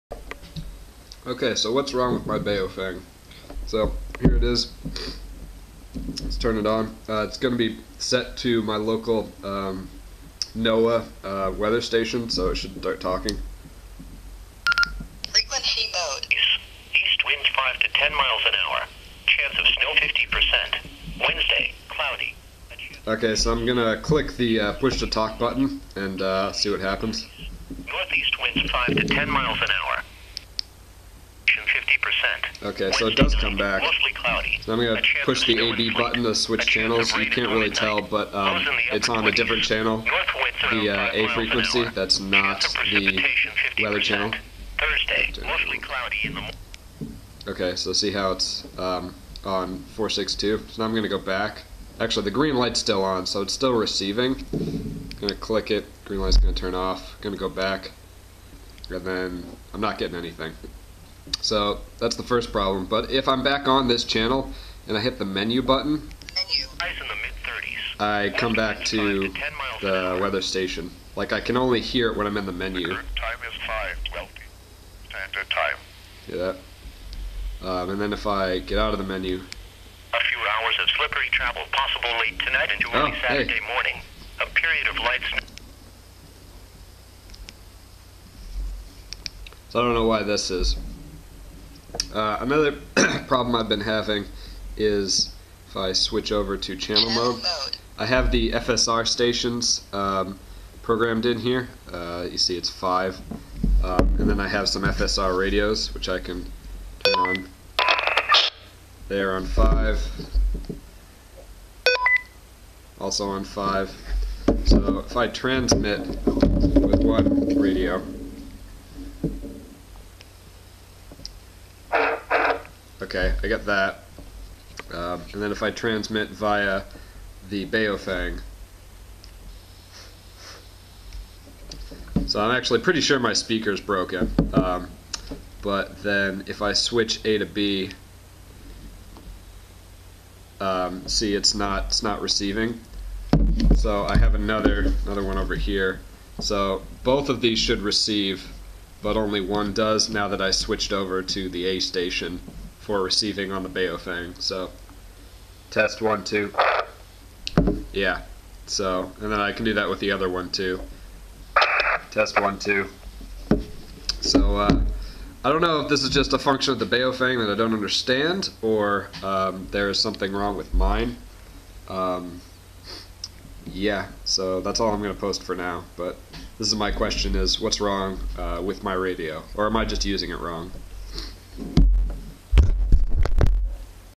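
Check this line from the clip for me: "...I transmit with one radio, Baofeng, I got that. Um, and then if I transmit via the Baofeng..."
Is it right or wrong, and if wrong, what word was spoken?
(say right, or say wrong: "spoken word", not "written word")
wrong: "Okay", not "Baofeng".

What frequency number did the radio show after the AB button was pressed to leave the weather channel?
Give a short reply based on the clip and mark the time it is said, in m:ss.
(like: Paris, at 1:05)
462, at 0:49.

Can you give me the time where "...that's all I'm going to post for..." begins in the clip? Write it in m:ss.
2:54.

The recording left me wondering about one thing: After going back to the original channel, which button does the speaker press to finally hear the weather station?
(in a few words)
menu button.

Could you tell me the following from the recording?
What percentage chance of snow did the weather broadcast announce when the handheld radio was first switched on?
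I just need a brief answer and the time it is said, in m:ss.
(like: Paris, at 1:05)
50%, at 0:19.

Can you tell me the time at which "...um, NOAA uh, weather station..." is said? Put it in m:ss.
0:09.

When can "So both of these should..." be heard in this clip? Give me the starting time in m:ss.
2:26.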